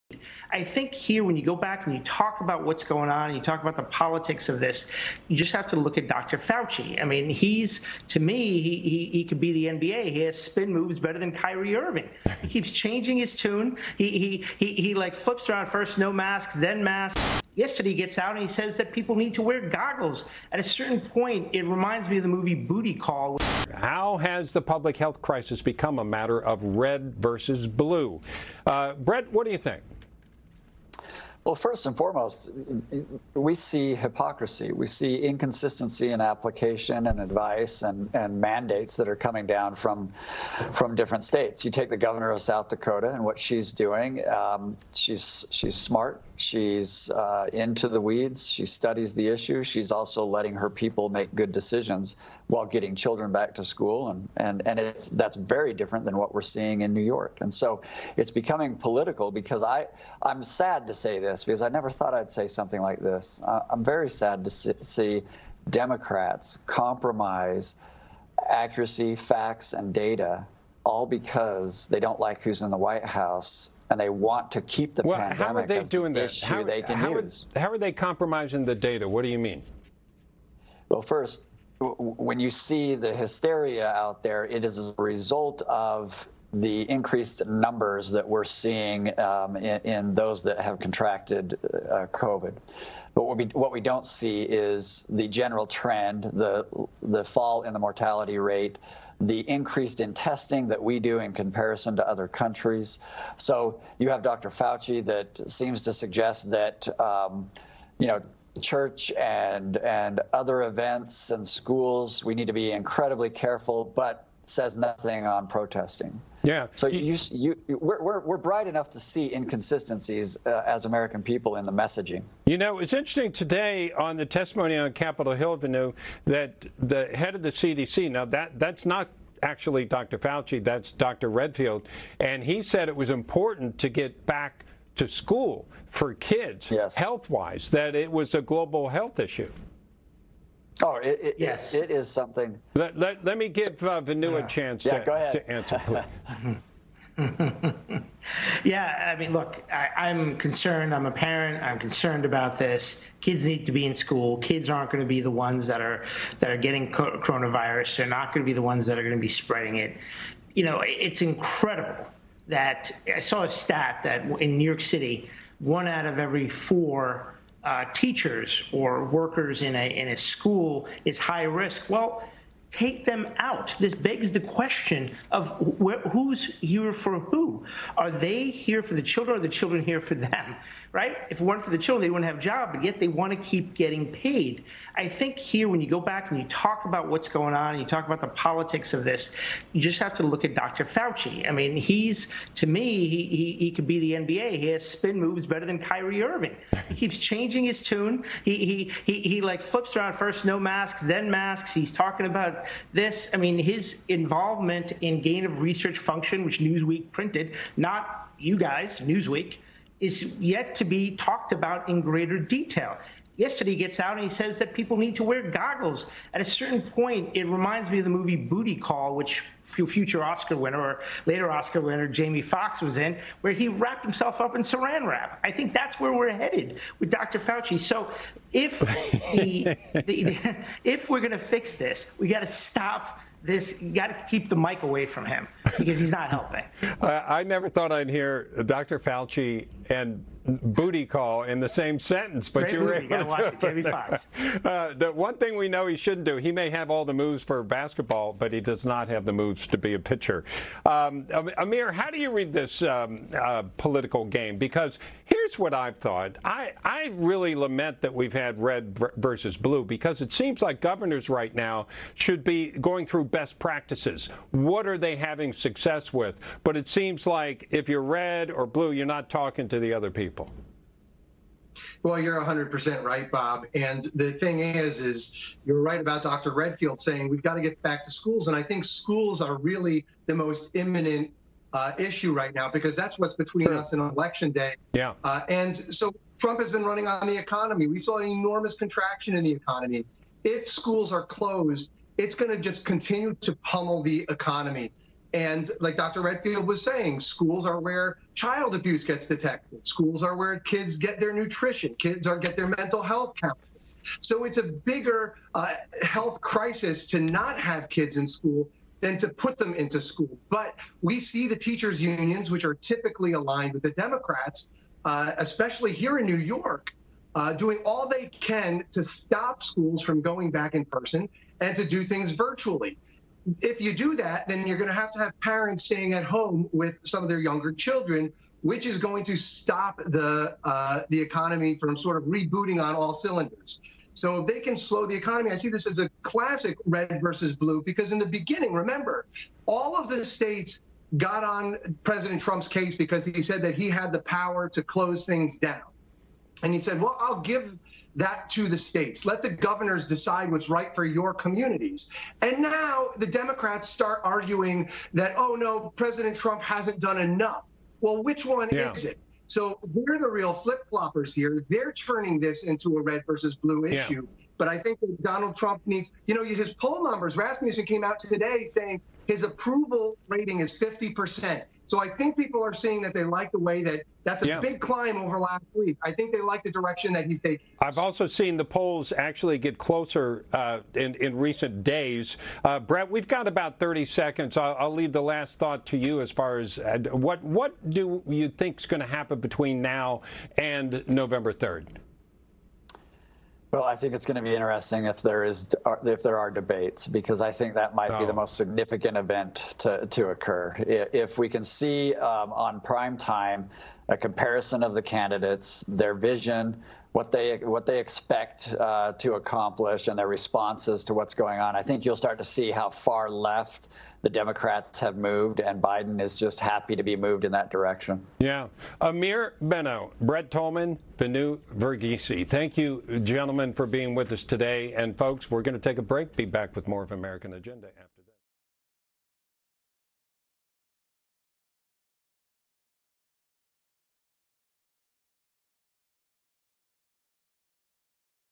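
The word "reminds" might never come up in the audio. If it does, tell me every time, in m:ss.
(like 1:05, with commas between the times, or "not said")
0:21, 3:37.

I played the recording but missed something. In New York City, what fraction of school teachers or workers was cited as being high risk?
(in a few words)
one out of every four.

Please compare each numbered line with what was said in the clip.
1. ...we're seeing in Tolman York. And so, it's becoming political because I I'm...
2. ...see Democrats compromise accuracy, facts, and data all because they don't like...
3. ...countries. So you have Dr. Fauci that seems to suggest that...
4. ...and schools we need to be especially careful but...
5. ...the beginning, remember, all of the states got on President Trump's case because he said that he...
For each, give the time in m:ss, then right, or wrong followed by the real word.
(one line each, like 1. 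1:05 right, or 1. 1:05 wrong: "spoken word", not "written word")
1. 0:56 wrong: "New", not "Tolman"
2. 1:04 right
3. 1:42 right
4. 1:51 wrong: "incredibly", not "especially"
5. 5:38 right.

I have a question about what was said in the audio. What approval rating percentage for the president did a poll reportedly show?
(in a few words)
50%.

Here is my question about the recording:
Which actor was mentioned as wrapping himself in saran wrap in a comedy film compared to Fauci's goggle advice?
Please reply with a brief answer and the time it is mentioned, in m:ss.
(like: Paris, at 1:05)
Jamie Foxx, at 3:42.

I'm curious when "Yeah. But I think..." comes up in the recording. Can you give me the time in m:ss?
6:04.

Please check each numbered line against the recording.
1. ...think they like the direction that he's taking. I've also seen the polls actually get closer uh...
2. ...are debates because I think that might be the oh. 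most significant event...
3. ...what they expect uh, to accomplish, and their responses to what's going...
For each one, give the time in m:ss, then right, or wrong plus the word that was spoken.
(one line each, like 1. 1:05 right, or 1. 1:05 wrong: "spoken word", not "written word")
1. 6:16 right
2. 6:36 right
3. 6:47 right.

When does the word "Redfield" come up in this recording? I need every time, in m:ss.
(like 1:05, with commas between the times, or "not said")
2:11, 4:36, 4:56.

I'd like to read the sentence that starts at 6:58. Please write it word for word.
Yeah, Amir Beno, Brett Tolman, Vinoo Varghese.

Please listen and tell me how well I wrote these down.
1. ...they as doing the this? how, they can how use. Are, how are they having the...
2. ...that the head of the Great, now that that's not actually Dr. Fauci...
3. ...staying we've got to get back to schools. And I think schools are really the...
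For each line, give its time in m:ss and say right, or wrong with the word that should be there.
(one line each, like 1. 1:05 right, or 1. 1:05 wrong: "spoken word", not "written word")
1. 1:15 wrong: "compromising", not "having"
2. 2:06 wrong: "CDC", not "Great"
3. 4:37 wrong: "saying", not "staying".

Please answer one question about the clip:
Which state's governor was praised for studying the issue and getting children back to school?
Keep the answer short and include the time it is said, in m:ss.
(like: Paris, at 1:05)
South Dakota, at 0:42.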